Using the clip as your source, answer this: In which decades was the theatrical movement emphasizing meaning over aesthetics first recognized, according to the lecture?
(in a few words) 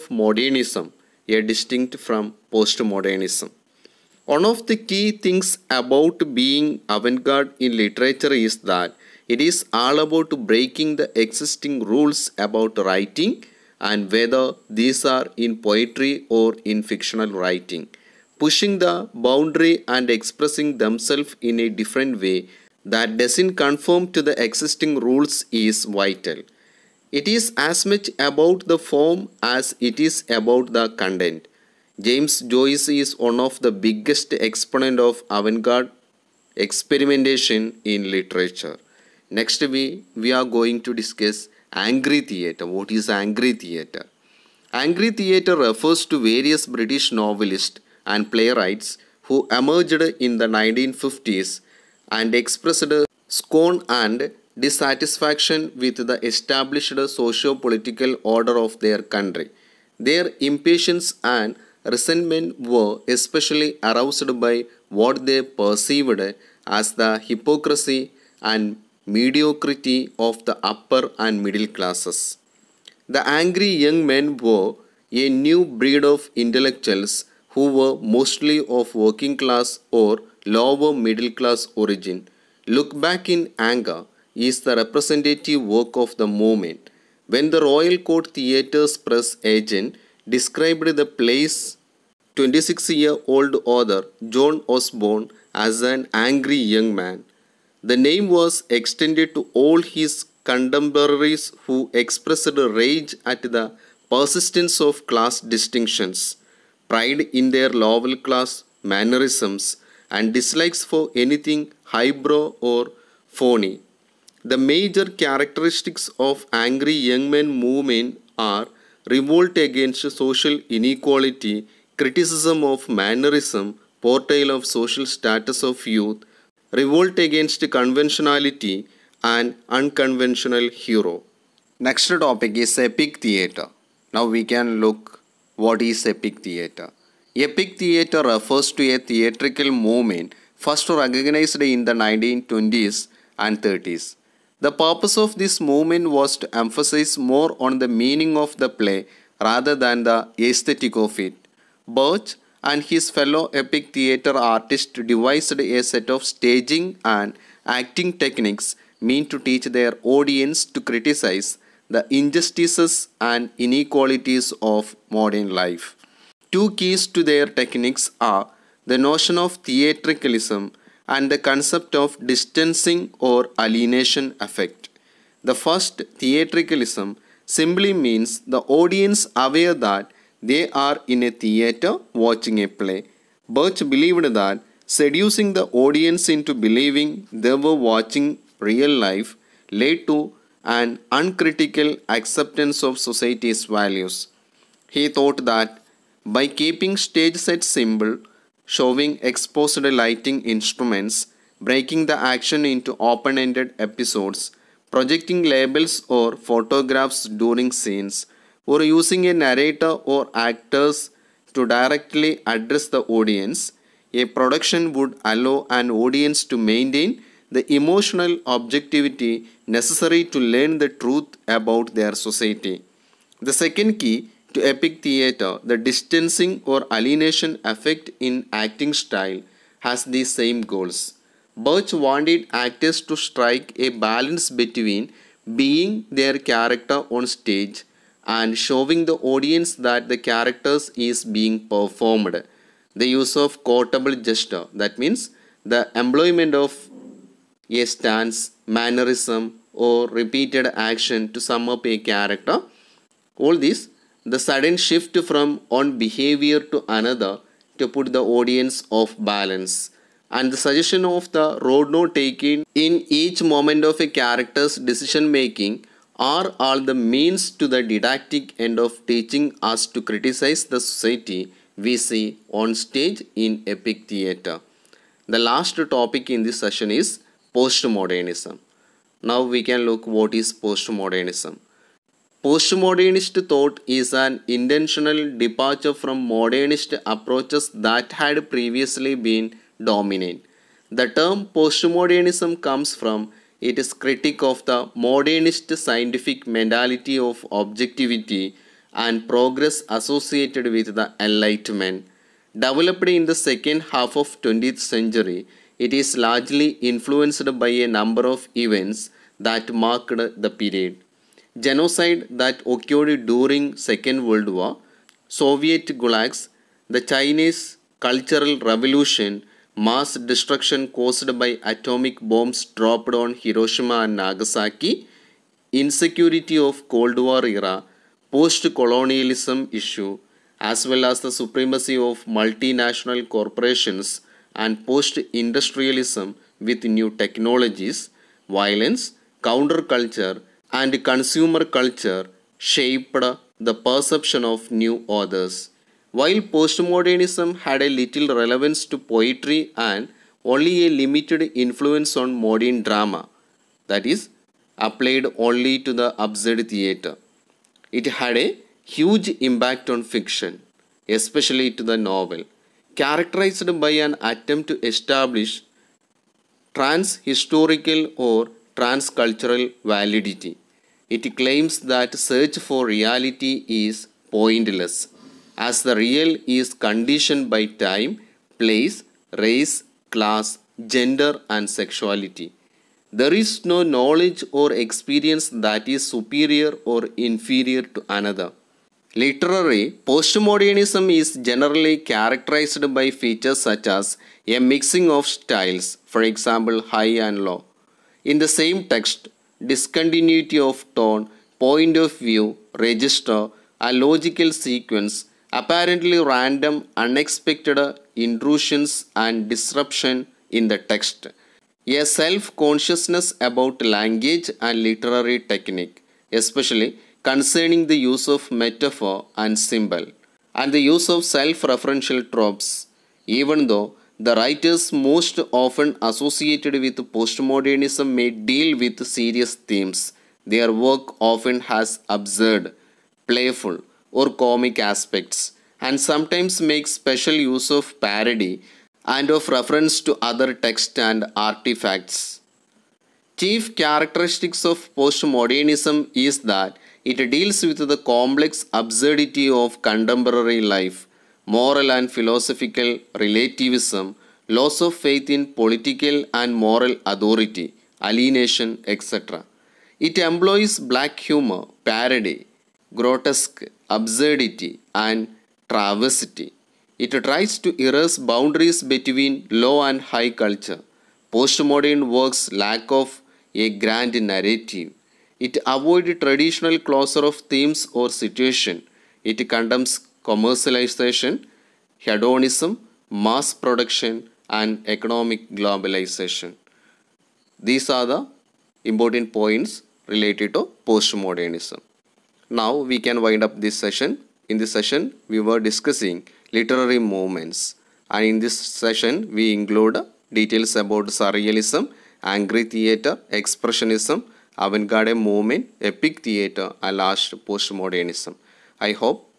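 1920s and 30s.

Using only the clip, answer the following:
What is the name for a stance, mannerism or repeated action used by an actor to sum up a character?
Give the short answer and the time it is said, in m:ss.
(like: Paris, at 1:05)
quotable gesture, at 4:03.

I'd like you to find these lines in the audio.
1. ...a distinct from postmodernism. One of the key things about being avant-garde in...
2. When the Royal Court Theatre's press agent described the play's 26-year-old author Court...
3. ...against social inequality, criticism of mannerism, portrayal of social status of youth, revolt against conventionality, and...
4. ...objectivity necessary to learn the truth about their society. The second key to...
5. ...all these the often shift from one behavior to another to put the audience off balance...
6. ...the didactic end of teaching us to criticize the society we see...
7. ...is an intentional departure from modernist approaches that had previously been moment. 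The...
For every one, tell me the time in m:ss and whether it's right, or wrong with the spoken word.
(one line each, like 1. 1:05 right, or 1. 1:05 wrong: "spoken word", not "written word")
1. 0:01 right
2. 1:27 wrong: "John", not "Court"
3. 1:59 right
4. 3:38 right
5. 4:13 wrong: "sudden", not "often"
6. 4:27 right
7. 4:43 wrong: "dominant", not "moment".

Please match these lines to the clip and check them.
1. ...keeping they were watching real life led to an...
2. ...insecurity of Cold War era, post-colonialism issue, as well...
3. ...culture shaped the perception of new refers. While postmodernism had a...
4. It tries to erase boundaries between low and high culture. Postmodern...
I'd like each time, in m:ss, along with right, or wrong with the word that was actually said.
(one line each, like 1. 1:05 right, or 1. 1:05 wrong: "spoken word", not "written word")
1. 3:06 wrong: "believing", not "keeping"
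2. 5:25 right
3. 5:41 wrong: "authors", not "refers"
4. 7:46 right.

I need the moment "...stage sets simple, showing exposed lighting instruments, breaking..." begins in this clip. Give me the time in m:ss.
3:16.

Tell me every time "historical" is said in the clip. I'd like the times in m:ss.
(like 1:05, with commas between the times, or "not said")
6:07.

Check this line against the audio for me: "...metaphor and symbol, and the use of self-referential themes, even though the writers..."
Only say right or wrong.
wrong.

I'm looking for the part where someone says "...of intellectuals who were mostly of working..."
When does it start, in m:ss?
1:16.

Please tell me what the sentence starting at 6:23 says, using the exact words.
There is no knowledge or experience that is superior or inferior to another.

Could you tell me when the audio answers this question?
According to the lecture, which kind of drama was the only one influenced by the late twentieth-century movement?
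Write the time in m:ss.
5:56.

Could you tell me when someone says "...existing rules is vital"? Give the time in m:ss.
0:24.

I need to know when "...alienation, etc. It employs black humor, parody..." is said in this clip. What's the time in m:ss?
7:38.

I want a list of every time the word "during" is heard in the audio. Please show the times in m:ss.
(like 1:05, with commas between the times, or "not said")
3:27, 5:13.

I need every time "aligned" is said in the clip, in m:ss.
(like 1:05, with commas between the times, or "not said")
not said.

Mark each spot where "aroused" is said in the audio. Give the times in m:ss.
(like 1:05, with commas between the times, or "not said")
1:03.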